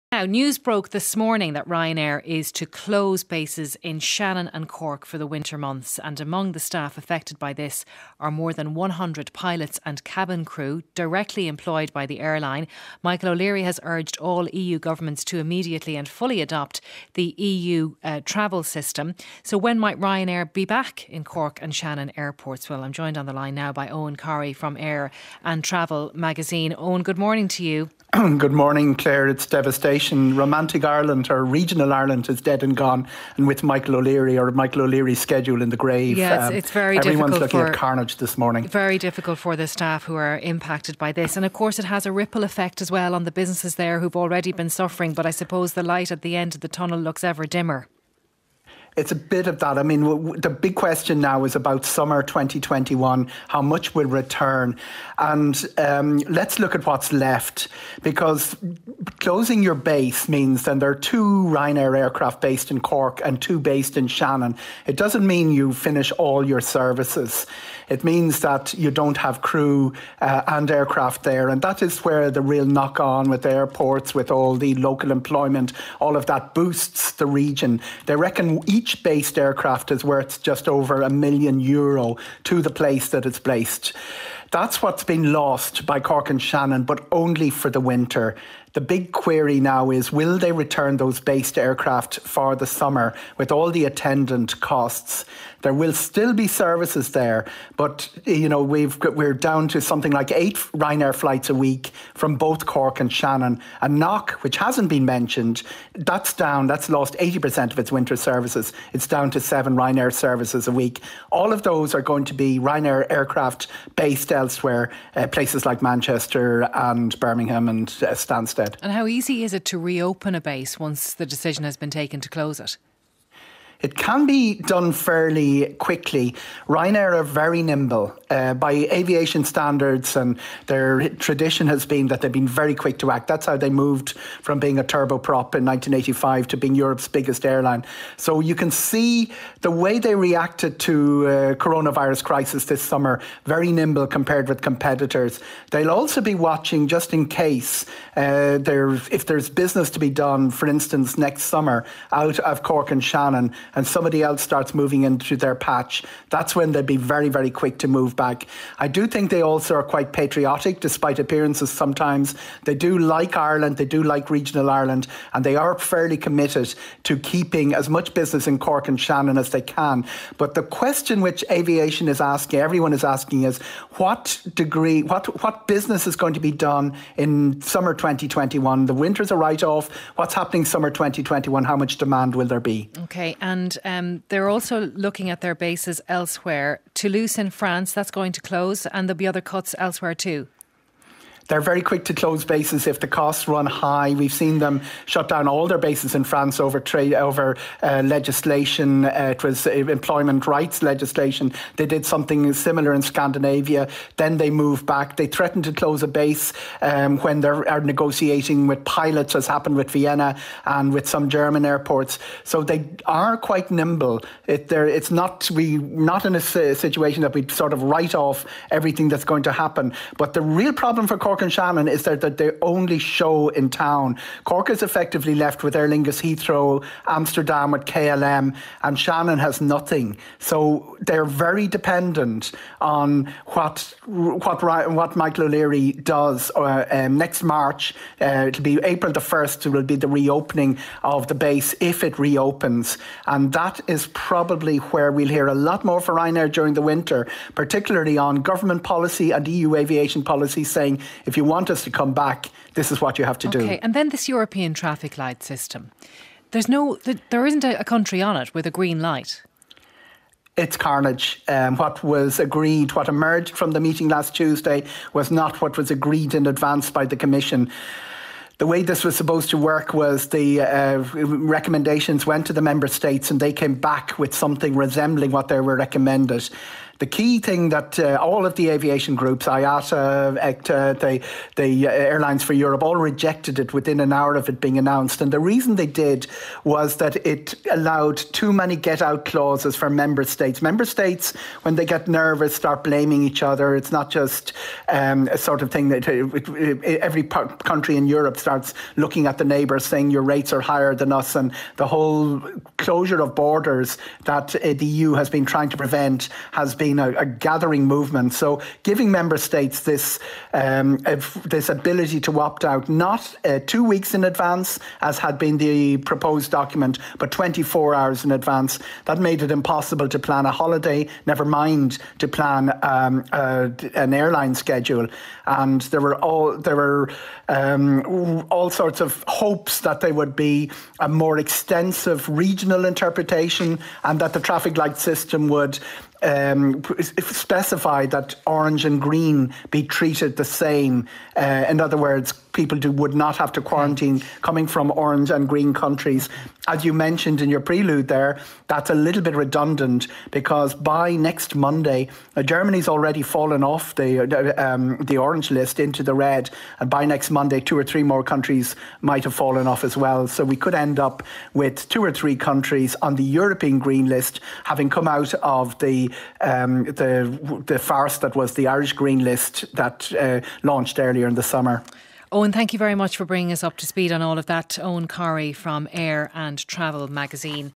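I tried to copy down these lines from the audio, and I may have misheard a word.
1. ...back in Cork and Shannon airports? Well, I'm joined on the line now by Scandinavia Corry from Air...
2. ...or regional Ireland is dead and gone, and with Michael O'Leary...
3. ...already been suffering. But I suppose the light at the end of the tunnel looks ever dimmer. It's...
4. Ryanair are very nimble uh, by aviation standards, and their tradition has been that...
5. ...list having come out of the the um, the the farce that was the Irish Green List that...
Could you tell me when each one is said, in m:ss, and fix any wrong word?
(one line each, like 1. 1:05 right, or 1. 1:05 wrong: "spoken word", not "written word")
1. 0:20 wrong: "Eoghan", not "Scandinavia"
2. 0:31 right
3. 0:44 right
4. 2:06 right
5. 6:04 right.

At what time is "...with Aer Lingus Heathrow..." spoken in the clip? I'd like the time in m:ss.
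3:45.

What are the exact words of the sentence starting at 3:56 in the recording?
Uh, um, next March, uh, it'll be April the first.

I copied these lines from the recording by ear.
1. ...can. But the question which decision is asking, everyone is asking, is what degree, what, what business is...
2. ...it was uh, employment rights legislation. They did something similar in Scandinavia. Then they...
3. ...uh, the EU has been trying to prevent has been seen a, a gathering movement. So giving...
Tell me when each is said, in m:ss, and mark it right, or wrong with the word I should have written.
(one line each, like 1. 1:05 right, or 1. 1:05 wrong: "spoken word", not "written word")
1. 2:49 wrong: "aviation", not "decision"
2. 3:19 right
3. 5:04 right.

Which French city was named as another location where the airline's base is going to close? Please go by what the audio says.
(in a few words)
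Toulouse.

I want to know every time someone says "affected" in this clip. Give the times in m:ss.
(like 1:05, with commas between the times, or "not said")
0:06.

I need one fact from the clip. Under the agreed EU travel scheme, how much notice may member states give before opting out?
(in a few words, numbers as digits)
24 hours.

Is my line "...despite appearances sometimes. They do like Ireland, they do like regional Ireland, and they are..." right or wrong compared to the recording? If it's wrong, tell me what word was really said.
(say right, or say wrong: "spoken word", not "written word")
right.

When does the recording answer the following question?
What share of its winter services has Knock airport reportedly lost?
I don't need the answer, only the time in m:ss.
1:47.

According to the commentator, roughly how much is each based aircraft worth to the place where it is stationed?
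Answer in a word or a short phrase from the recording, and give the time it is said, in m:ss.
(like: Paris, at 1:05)
just over a million euro, at 1:20.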